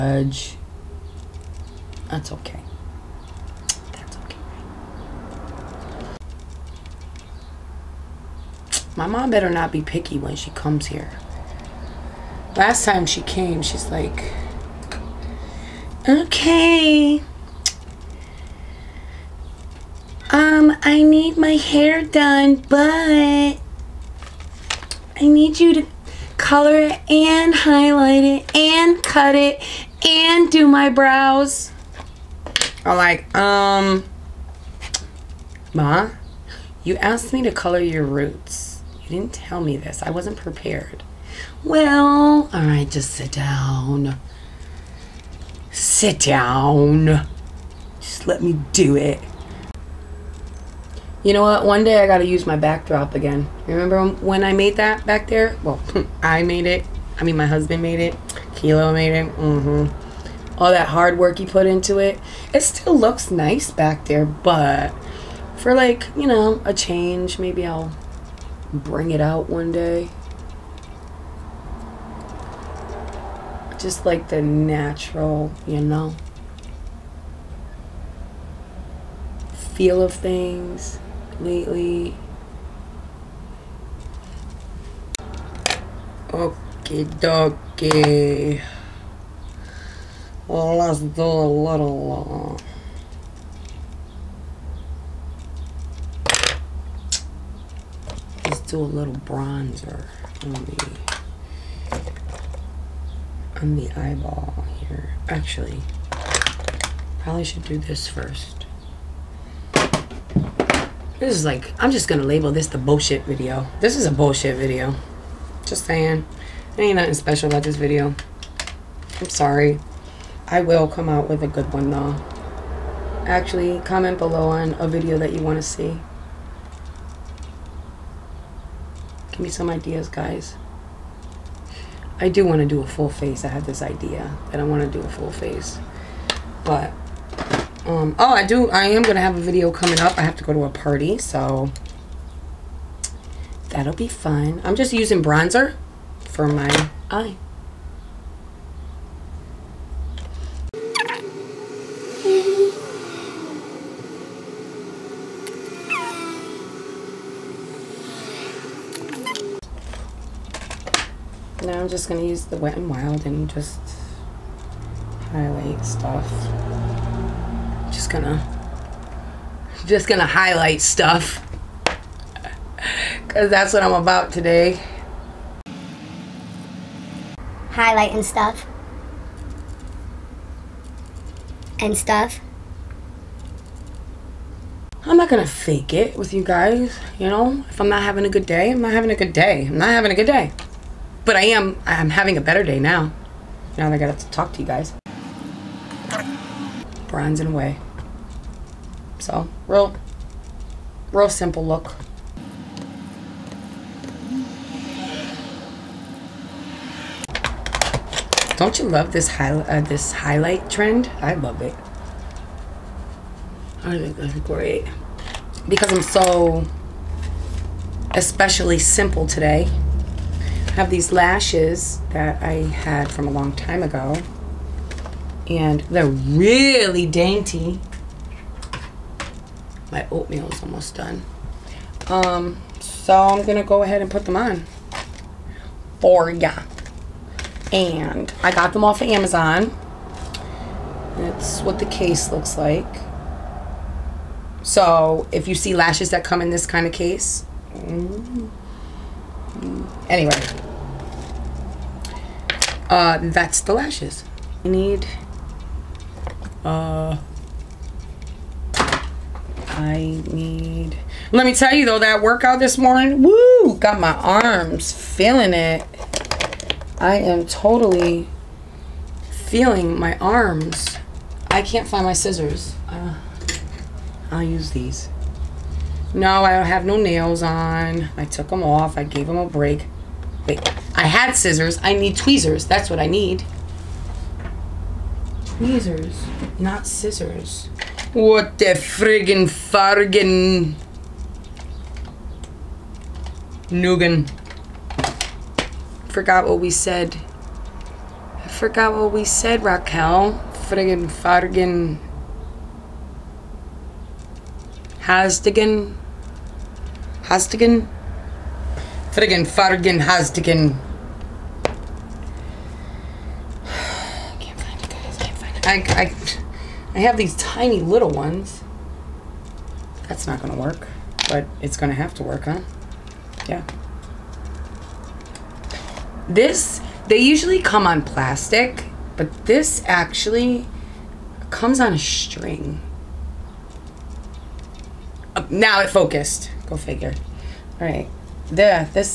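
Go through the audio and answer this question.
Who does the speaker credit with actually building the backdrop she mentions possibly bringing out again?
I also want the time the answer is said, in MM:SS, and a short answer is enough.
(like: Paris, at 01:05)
Kilo, at 00:58.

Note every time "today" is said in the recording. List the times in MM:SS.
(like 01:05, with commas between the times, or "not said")
02:54, 03:39.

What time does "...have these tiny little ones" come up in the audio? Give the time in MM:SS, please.
05:17.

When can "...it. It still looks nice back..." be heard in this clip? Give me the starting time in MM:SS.
01:01.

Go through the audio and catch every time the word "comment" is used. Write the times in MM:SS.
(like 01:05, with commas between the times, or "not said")
02:03.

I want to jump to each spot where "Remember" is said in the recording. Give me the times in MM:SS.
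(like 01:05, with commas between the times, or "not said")
00:53.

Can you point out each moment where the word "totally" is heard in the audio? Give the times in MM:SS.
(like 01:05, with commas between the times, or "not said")
04:27.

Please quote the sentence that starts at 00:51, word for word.
One day I got to use my backdrop again.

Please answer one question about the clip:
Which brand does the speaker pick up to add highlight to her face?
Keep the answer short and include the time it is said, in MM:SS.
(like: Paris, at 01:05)
Wet n Wild, at 02:42.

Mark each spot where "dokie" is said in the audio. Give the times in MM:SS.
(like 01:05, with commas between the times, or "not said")
01:27.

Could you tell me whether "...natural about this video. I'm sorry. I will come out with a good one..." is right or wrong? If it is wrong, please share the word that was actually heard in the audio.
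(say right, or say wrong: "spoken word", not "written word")
wrong: "special", not "natural".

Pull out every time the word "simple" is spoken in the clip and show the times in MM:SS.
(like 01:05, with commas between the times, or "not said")
03:21, 03:38.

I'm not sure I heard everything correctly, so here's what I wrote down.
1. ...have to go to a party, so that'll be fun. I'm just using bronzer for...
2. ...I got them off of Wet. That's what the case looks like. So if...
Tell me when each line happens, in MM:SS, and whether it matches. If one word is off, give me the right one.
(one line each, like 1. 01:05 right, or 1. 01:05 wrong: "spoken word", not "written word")
1. 02:20 right
2. 03:58 wrong: "Amazon", not "Wet".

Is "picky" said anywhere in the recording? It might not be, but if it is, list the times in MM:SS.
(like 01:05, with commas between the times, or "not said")
00:09.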